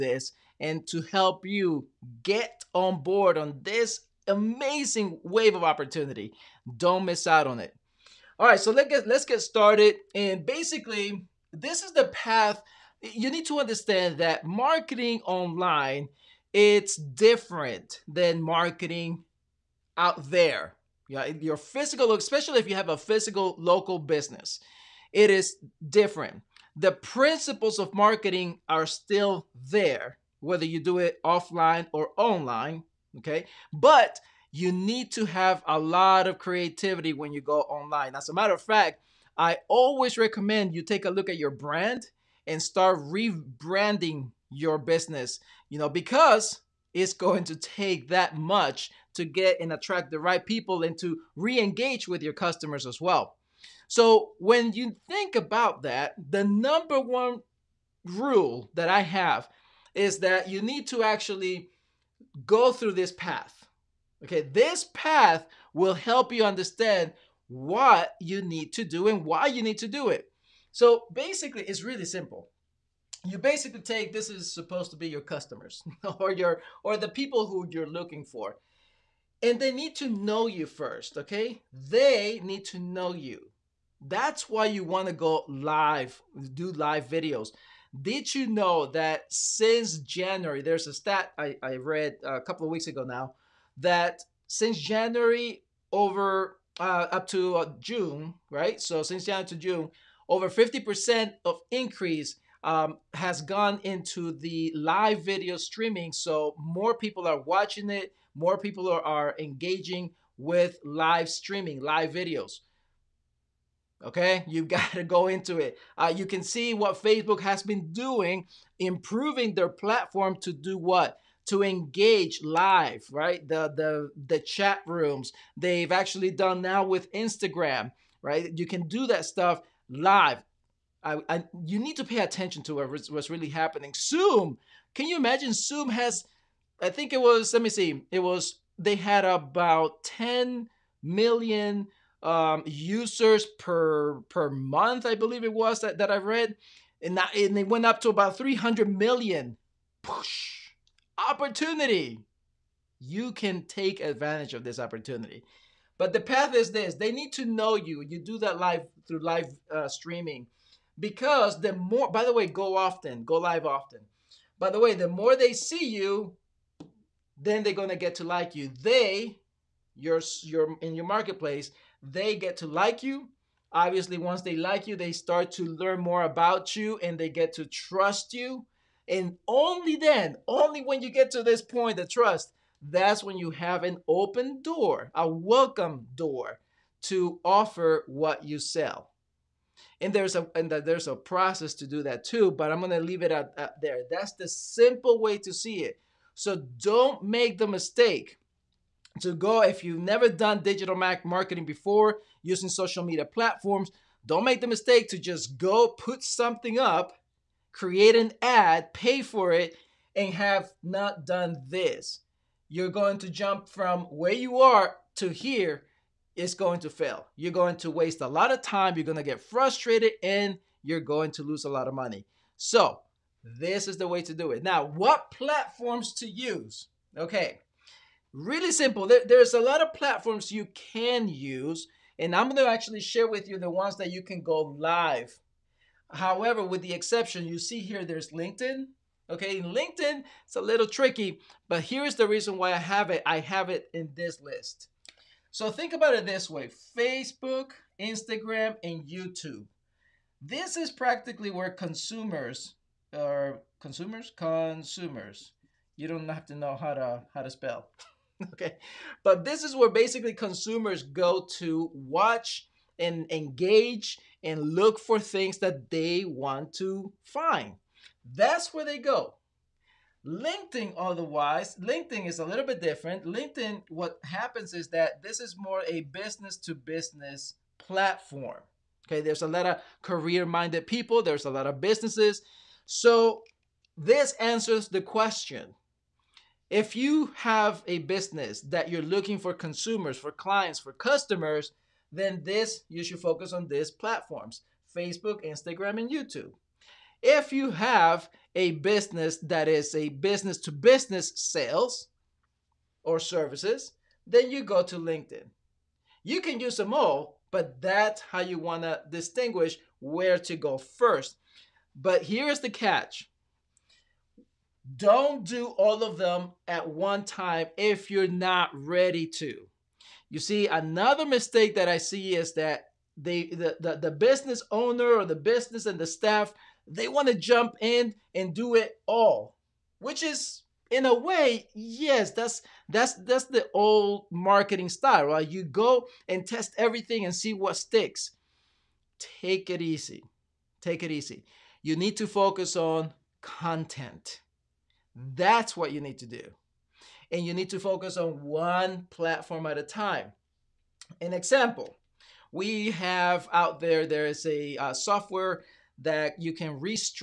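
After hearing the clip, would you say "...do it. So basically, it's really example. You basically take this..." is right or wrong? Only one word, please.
wrong.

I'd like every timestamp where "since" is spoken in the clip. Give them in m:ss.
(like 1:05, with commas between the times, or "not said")
1:29, 1:34, 1:39.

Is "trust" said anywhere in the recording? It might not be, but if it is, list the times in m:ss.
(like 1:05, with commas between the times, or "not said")
2:57, 3:02.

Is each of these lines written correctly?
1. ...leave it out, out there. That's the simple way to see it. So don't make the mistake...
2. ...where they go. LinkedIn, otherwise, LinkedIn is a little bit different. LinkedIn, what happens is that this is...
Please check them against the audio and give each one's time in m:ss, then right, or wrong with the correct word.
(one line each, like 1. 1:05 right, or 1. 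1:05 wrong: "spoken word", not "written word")
1. 3:13 right
2. 4:28 right.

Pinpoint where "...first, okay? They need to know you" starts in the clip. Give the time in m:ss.
1:20.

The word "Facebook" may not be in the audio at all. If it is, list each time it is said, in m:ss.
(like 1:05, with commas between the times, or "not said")
1:57, 4:06, 4:54.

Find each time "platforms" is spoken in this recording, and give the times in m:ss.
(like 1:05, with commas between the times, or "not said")
1:59, 3:23, 3:45, 3:49, 4:37, 4:53, 5:49.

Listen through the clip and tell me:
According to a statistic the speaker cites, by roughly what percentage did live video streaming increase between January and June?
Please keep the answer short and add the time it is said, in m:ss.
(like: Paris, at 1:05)
50%, at 1:40.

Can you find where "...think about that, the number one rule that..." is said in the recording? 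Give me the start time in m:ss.
0:55.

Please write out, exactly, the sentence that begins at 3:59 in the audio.
Okay, in LinkedIn, it's a little tricky, but here's the reason why I have it.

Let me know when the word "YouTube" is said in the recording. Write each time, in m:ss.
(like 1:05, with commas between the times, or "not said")
4:09, 4:56.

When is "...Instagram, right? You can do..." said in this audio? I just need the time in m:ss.
2:07.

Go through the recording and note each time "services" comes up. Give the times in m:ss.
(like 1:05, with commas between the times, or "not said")
5:03.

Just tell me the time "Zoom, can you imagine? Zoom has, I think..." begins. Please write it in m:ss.
2:13.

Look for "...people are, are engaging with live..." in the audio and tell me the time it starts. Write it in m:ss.
1:48.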